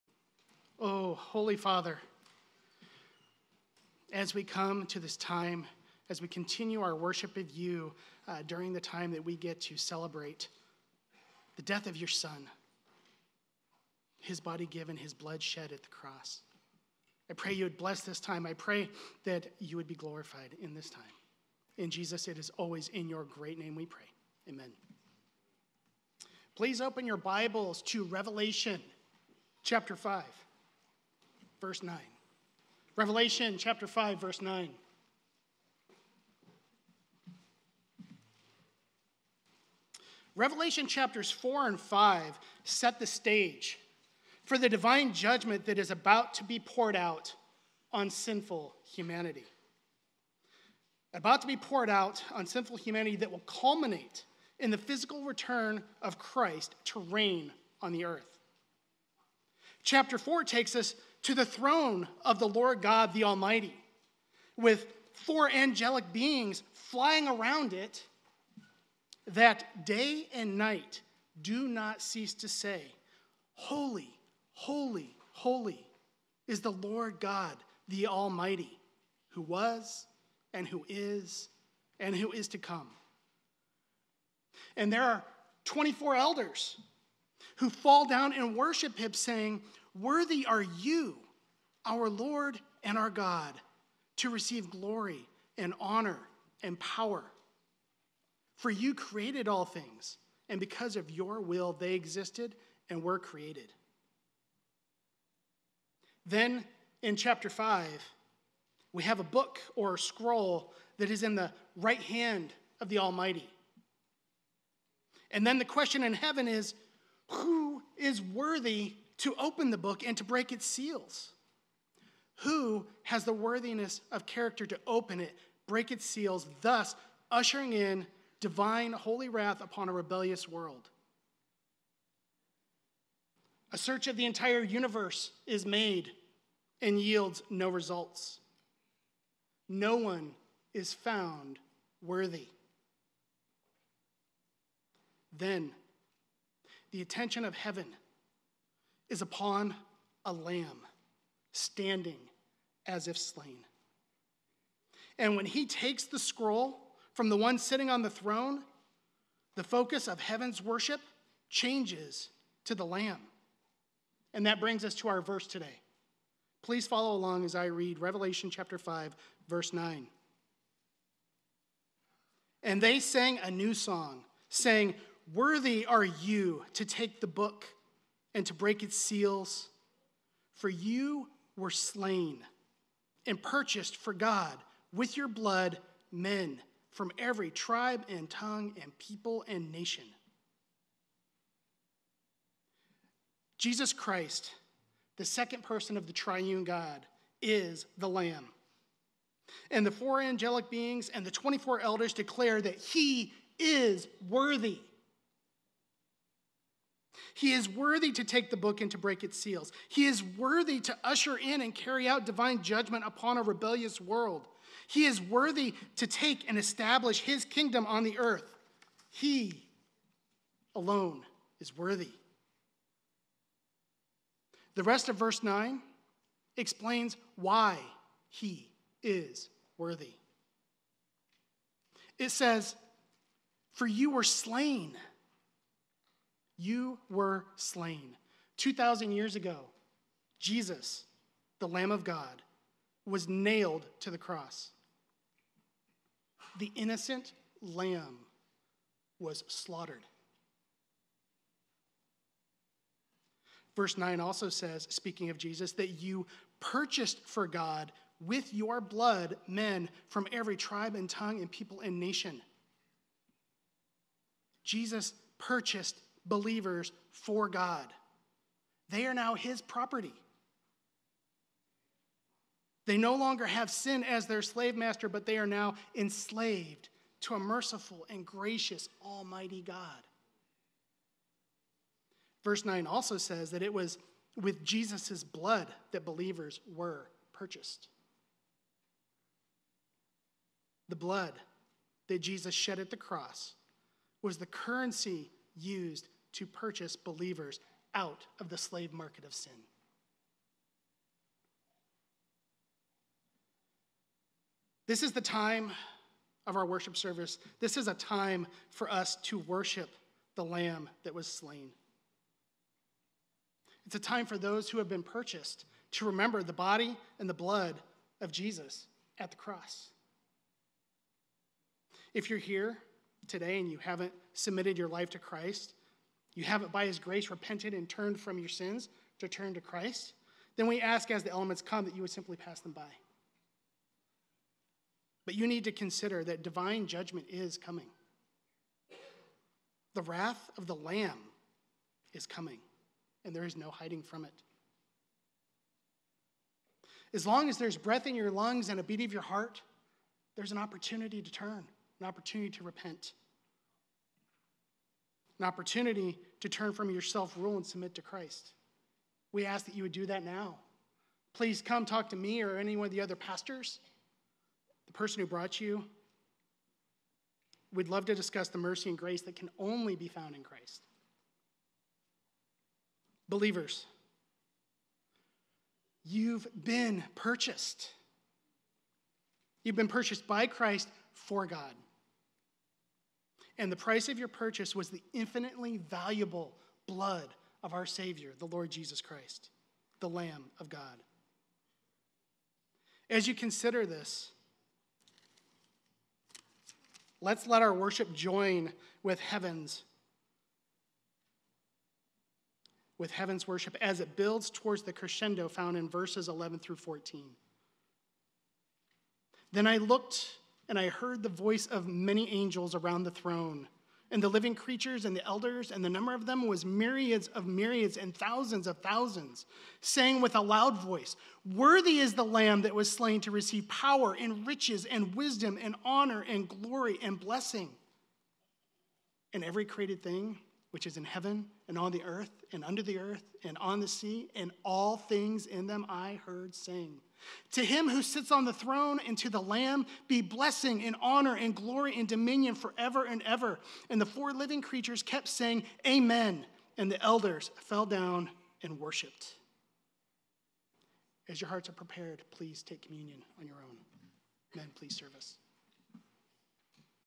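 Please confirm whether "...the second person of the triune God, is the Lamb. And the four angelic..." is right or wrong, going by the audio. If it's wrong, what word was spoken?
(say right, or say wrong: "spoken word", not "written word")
right.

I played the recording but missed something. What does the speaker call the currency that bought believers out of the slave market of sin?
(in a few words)
Jesus' blood.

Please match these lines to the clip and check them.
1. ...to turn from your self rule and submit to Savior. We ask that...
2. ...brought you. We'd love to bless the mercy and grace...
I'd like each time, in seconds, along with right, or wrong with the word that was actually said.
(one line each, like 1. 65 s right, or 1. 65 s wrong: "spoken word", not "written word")
1. 356 s wrong: "Christ", not "Savior"
2. 365 s wrong: "discuss", not "bless".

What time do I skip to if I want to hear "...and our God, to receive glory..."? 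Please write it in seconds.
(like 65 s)
92 s.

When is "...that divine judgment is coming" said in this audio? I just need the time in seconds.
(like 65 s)
336 s.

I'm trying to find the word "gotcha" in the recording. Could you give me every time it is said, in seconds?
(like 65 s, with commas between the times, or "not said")
not said.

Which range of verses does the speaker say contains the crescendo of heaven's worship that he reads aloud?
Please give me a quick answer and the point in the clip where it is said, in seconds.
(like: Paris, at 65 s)
verses 11 through 14, at 405 s.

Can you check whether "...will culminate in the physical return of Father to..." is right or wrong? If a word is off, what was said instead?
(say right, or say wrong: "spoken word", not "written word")
wrong: "Christ", not "Father".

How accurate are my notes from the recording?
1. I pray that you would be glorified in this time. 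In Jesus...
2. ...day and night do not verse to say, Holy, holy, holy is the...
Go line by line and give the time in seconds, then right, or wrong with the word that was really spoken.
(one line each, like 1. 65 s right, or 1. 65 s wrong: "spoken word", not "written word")
1. 18 s right
2. 69 s wrong: "cease", not "verse".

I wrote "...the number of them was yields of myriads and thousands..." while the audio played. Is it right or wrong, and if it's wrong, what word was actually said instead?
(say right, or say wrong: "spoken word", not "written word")
wrong: "myriads", not "yields".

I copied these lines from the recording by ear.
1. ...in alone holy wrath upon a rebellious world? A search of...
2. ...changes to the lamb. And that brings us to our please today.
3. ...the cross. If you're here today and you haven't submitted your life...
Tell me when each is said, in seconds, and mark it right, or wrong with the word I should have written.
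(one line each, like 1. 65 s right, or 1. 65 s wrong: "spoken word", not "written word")
1. 127 s wrong: "divine", not "alone"
2. 161 s wrong: "verse", not "please"
3. 319 s right.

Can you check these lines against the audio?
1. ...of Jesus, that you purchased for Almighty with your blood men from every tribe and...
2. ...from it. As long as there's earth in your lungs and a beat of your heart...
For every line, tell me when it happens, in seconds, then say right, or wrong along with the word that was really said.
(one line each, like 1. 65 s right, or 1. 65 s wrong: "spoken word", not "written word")
1. 255 s wrong: "God", not "Almighty"
2. 344 s wrong: "breath", not "earth".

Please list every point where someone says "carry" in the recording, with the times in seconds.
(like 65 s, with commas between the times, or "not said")
211 s.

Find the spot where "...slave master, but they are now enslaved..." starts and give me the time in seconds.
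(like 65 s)
274 s.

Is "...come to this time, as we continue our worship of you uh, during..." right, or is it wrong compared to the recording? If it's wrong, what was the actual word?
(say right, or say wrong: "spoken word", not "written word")
right.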